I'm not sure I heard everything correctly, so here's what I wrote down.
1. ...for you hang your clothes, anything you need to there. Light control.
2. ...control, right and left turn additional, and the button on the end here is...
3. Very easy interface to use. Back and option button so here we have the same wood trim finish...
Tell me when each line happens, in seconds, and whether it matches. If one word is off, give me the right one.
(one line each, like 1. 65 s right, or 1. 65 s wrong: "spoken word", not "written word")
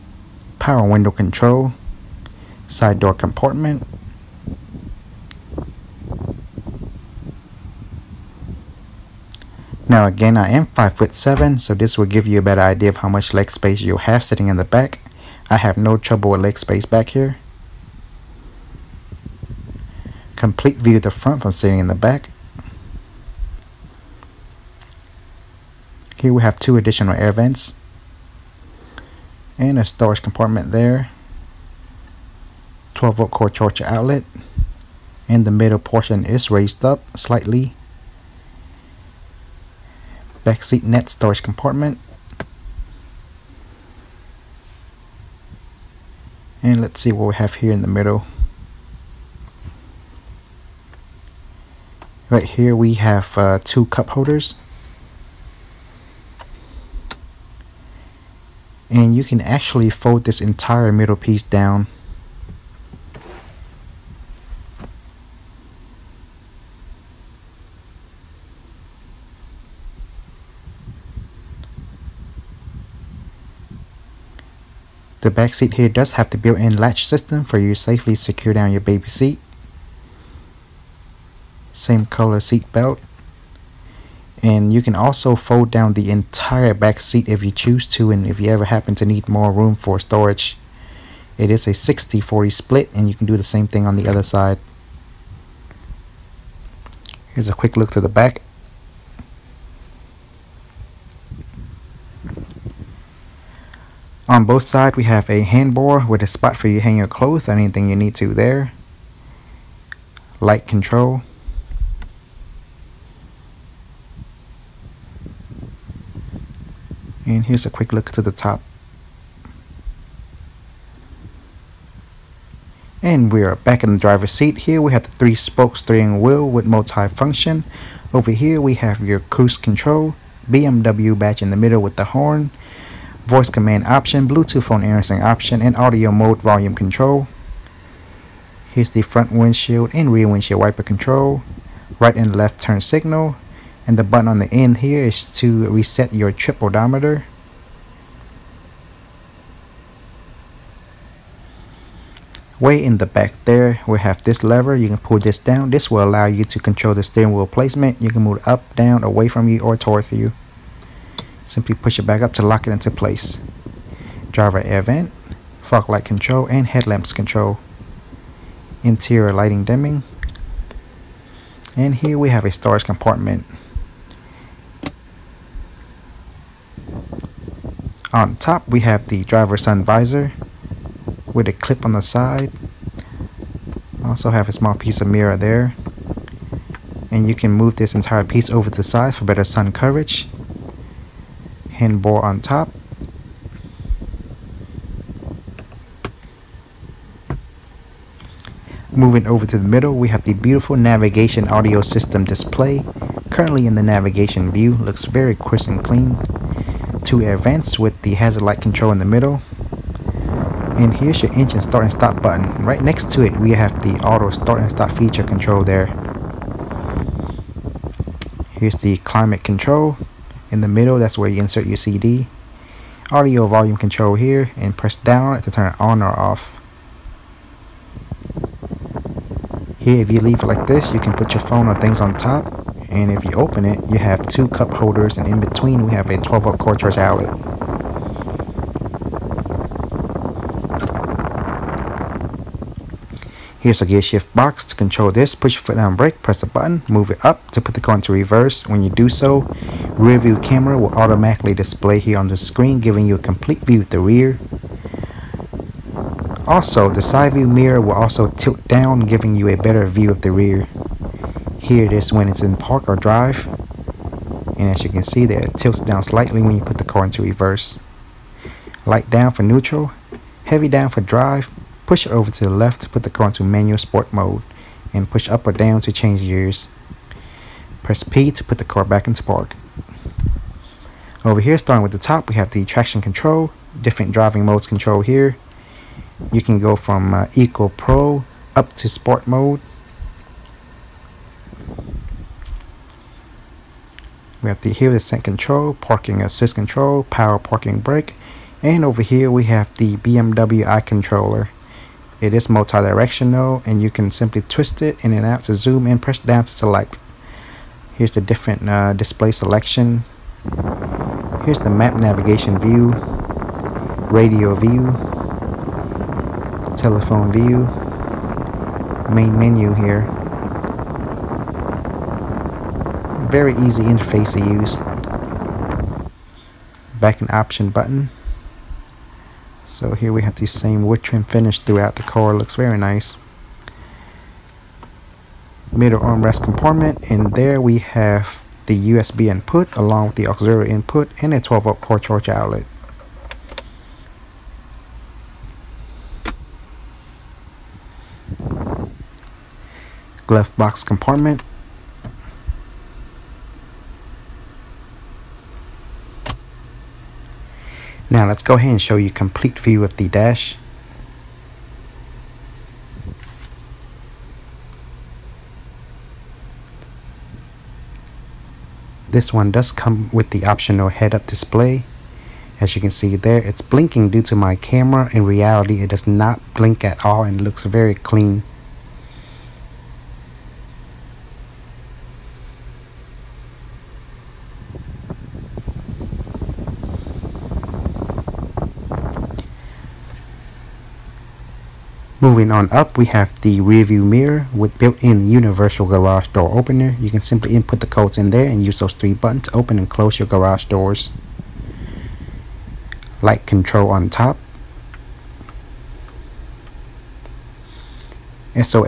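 1. 106 s right
2. 140 s wrong: "signal", not "additional"
3. 323 s right.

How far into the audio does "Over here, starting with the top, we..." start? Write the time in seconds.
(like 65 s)
281 s.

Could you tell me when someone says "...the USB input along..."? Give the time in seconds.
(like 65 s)
338 s.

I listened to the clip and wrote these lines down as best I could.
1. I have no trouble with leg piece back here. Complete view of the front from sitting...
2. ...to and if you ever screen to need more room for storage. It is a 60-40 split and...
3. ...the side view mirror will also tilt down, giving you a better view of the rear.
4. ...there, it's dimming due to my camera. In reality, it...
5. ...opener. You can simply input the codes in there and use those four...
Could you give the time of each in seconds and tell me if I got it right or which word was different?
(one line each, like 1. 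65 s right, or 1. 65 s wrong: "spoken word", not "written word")
1. 15 s wrong: "space", not "piece"
2. 87 s wrong: "happen", not "screen"
3. 256 s right
4. 373 s wrong: "blinking", not "dimming"
5. 396 s wrong: "three", not "four".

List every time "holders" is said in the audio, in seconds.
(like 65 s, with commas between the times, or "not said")
54 s, 234 s.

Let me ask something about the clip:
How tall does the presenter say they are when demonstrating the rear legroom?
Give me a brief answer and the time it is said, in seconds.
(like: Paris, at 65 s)
5 foot 7, at 10 s.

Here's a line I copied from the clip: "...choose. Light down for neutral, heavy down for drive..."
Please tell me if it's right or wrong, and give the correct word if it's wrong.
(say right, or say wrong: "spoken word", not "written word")
wrong: "reverse", not "choose".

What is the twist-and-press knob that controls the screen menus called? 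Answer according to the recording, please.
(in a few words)
BMW i controller.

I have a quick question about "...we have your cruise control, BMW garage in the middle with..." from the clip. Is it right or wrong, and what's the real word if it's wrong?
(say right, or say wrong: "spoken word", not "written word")
wrong: "badge", not "garage".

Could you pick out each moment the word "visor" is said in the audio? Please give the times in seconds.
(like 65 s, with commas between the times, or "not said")
179 s.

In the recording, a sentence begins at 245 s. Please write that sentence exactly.
Push your foot down brake, press the button, move it up to put the car into reverse.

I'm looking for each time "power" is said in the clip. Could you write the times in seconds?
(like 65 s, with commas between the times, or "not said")
0 s, 297 s.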